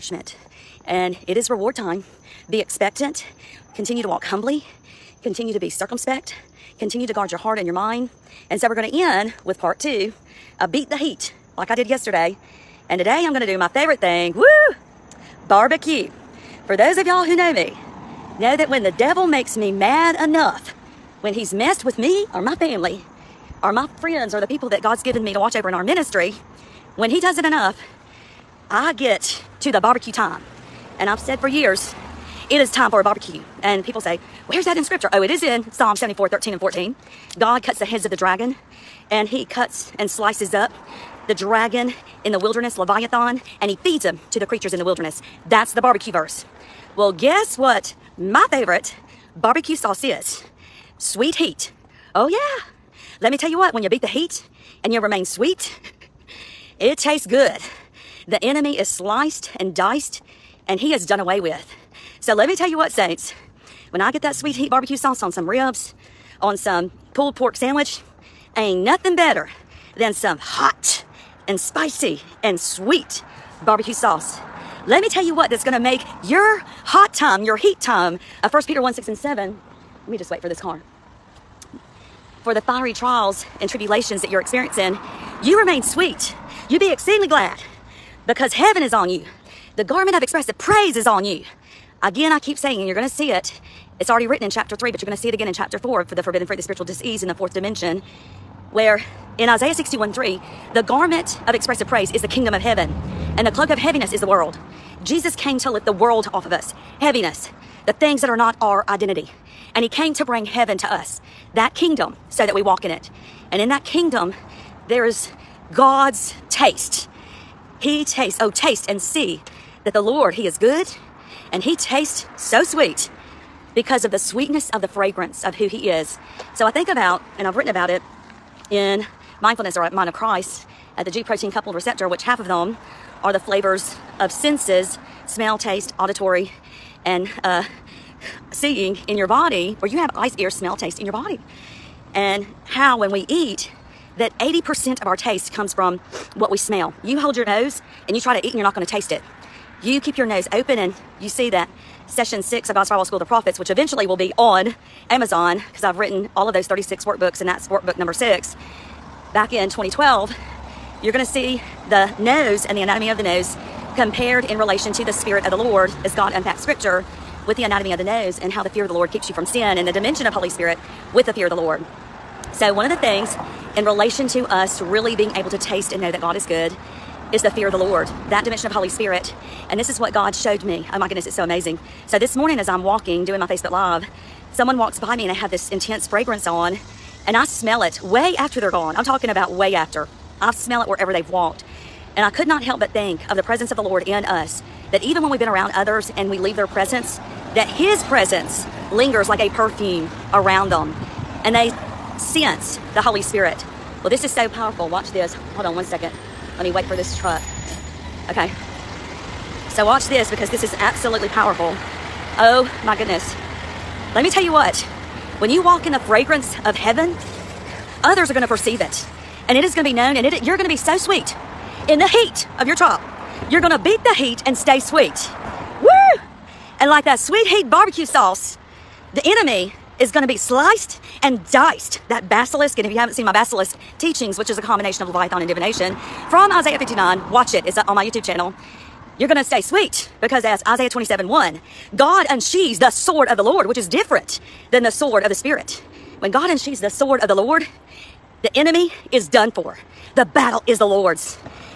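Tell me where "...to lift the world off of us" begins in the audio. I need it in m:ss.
1:45.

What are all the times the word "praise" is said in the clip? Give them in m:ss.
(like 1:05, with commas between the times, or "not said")
1:30, 1:41.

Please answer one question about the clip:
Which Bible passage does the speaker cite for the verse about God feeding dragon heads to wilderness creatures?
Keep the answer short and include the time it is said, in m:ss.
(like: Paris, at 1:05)
Psalm 74:13-14, at 0:35.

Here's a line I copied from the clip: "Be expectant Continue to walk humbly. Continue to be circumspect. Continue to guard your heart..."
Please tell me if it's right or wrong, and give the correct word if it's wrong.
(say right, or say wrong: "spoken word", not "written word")
right.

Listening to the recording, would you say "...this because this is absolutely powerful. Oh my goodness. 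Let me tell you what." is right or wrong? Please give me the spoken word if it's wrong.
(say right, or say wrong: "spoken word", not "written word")
right.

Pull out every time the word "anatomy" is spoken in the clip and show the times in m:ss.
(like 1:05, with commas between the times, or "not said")
2:42, 2:47.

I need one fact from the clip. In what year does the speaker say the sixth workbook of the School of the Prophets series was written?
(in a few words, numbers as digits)
2012.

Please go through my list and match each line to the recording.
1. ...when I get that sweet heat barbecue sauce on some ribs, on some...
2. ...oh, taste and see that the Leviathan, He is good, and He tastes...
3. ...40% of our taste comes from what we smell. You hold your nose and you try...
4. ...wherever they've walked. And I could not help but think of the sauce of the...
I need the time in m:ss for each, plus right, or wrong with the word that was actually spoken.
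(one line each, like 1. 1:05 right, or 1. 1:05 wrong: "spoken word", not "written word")
1. 1:03 right
2. 1:58 wrong: "Lord", not "Leviathan"
3. 2:24 wrong: "80", not "40"
4. 3:10 wrong: "presence", not "sauce".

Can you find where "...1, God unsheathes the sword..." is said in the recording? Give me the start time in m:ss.
4:01.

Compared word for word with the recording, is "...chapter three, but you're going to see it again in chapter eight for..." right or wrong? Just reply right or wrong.
wrong.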